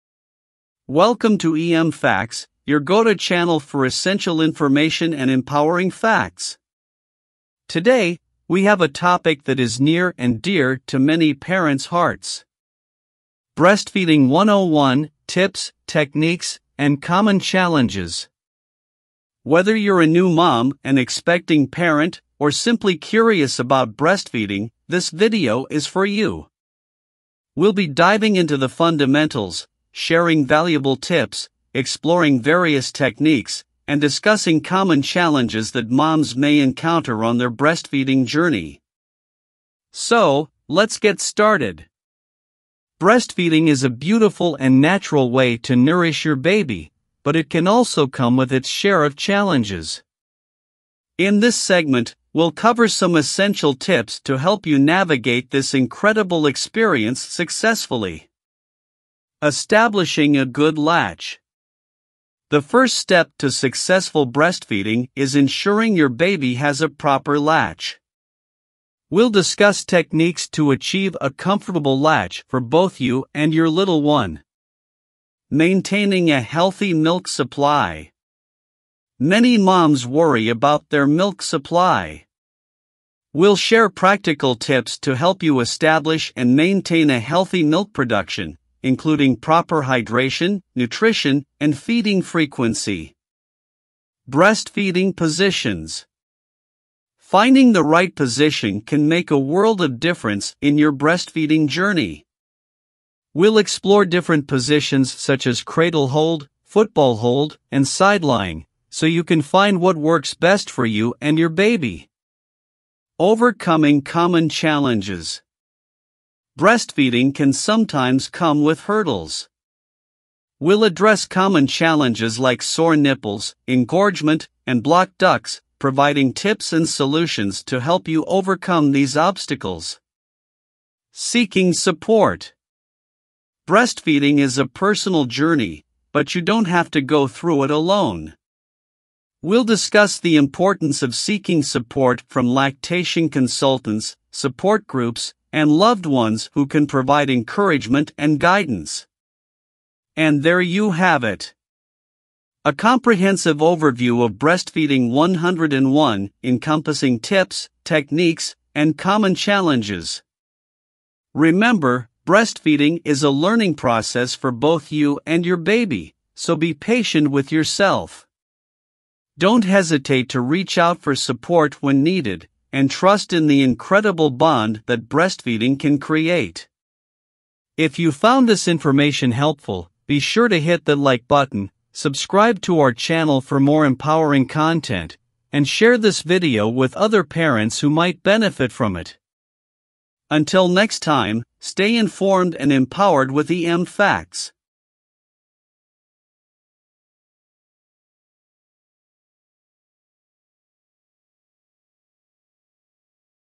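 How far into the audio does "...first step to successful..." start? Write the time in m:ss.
1:02.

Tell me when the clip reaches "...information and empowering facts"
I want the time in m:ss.
0:04.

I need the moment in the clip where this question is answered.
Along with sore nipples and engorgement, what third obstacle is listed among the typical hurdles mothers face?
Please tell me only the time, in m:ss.
2:04.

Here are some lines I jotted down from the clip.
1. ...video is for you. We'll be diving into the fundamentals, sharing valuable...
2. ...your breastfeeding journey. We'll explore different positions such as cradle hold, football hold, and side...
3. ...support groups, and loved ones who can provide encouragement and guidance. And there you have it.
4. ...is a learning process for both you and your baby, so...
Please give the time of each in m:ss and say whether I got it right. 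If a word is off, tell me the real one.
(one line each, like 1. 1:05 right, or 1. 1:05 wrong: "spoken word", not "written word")
1. 0:25 right
2. 1:40 right
3. 2:24 right
4. 2:43 right.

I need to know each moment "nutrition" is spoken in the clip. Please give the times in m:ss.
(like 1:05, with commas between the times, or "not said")
1:30.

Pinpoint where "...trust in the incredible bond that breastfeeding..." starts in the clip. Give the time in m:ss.
2:52.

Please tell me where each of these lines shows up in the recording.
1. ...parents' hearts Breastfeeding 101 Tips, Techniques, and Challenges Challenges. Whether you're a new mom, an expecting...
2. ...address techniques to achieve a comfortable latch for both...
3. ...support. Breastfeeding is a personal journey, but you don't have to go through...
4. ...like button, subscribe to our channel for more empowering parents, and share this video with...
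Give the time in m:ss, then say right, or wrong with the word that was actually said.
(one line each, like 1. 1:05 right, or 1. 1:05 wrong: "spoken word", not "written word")
1. 0:11 wrong: "Common", not "Challenges"
2. 1:09 wrong: "discuss", not "address"
3. 2:11 right
4. 3:00 wrong: "content", not "parents".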